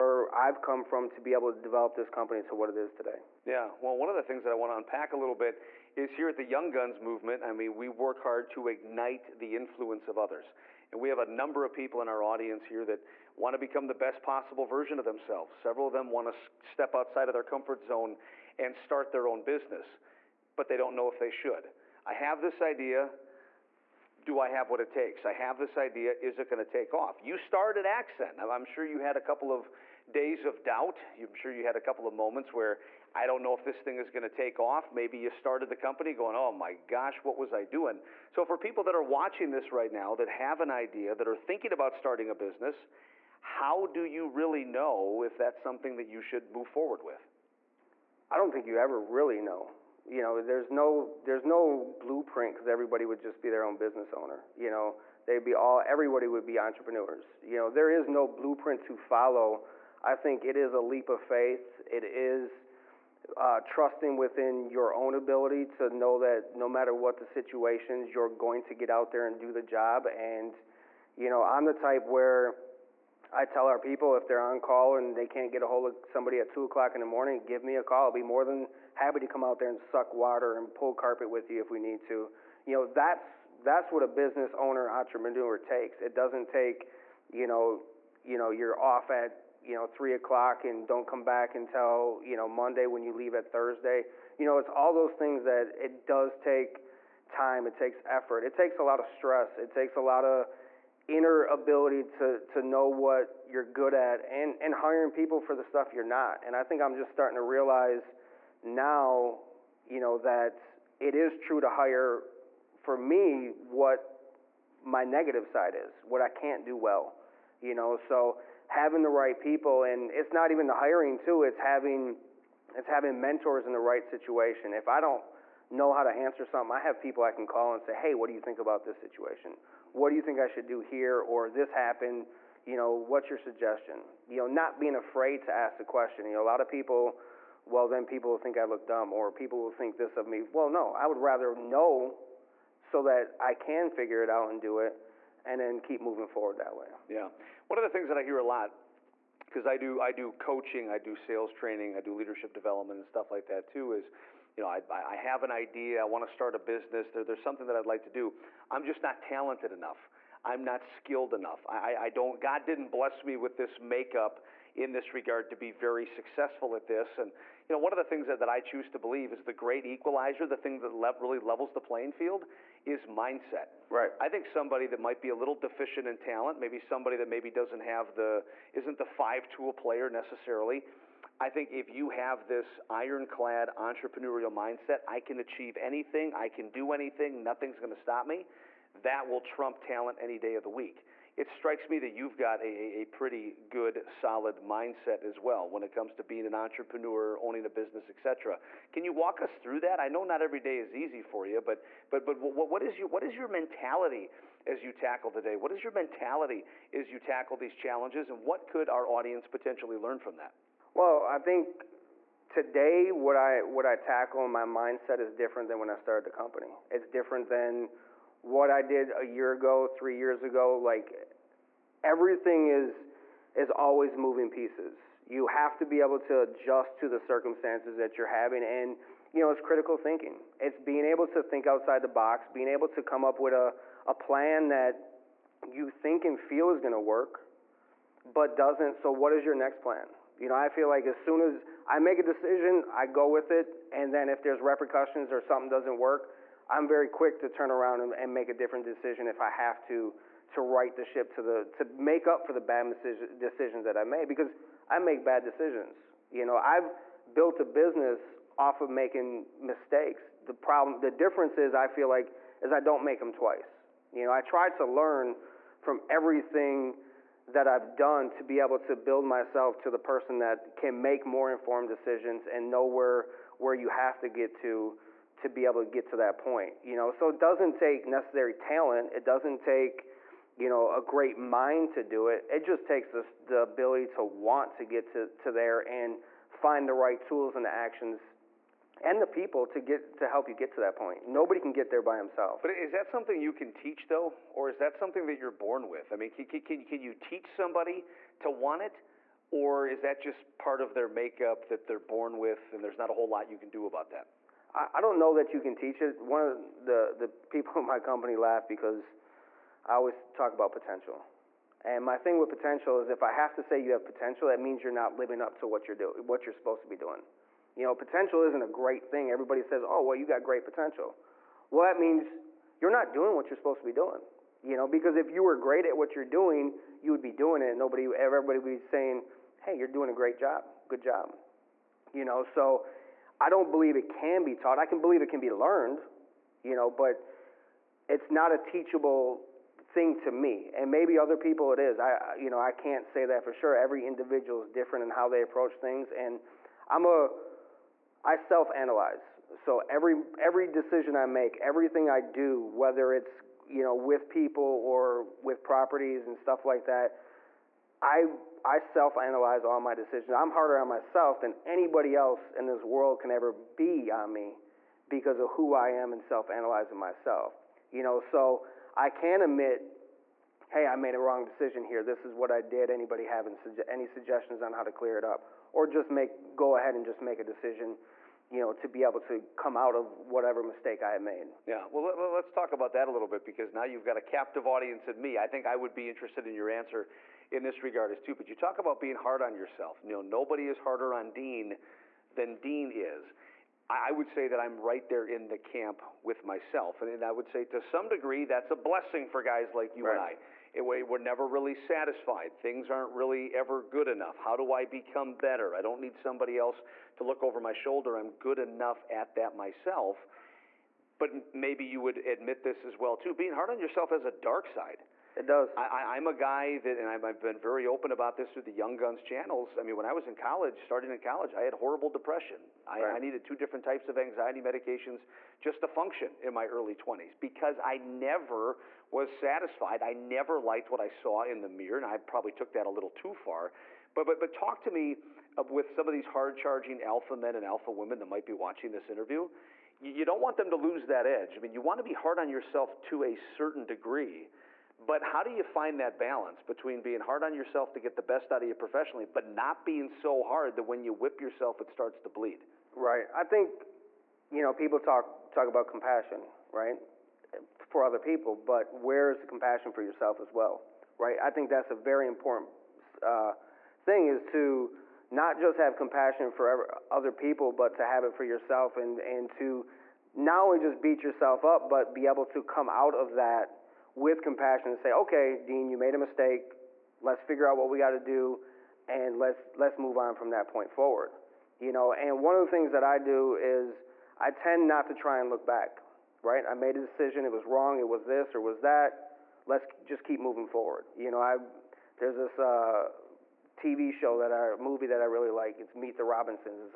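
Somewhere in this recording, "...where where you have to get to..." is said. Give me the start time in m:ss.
4:32.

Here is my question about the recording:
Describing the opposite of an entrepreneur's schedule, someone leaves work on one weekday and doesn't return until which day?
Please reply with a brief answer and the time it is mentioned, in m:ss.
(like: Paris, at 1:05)
Monday, at 1:32.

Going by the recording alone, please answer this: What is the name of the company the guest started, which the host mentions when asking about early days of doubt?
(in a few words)
Accent.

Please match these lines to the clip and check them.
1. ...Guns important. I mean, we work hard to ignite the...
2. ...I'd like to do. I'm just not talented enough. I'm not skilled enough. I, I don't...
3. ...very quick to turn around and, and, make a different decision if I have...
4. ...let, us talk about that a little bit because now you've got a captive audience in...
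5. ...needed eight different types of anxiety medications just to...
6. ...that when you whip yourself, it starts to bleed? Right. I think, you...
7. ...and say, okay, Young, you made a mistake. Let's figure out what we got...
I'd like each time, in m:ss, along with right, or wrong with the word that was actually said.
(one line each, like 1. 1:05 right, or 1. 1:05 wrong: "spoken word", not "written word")
1. 0:06 wrong: "movement", not "important"
2. 2:37 right
3. 4:06 right
4. 6:22 right
5. 7:03 wrong: "two", not "eight"
6. 7:30 right
7. 7:54 wrong: "Dean", not "Young".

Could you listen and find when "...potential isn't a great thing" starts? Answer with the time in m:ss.
5:17.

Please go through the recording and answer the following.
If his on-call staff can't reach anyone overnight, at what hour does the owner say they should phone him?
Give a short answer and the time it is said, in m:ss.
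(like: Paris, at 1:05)
2 in the morning, at 1:16.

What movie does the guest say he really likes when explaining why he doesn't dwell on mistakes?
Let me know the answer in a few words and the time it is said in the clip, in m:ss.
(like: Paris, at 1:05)
Meet the Robinsons, at 8:15.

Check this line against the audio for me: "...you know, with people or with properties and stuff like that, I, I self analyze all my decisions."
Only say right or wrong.
right.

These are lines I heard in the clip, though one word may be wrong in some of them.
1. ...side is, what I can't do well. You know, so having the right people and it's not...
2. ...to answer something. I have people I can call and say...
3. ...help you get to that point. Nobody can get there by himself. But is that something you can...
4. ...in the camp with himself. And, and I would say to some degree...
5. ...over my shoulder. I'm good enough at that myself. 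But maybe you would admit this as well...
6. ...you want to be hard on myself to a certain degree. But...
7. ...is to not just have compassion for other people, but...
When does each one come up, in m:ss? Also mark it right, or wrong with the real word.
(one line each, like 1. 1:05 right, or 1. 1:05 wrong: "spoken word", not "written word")
1. 1:55 right
2. 2:06 right
3. 4:50 right
4. 6:35 wrong: "myself", not "himself"
5. 6:47 right
6. 7:21 wrong: "yourself", not "myself"
7. 7:44 right.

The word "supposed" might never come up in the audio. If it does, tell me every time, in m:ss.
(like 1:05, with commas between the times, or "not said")
5:16, 5:23.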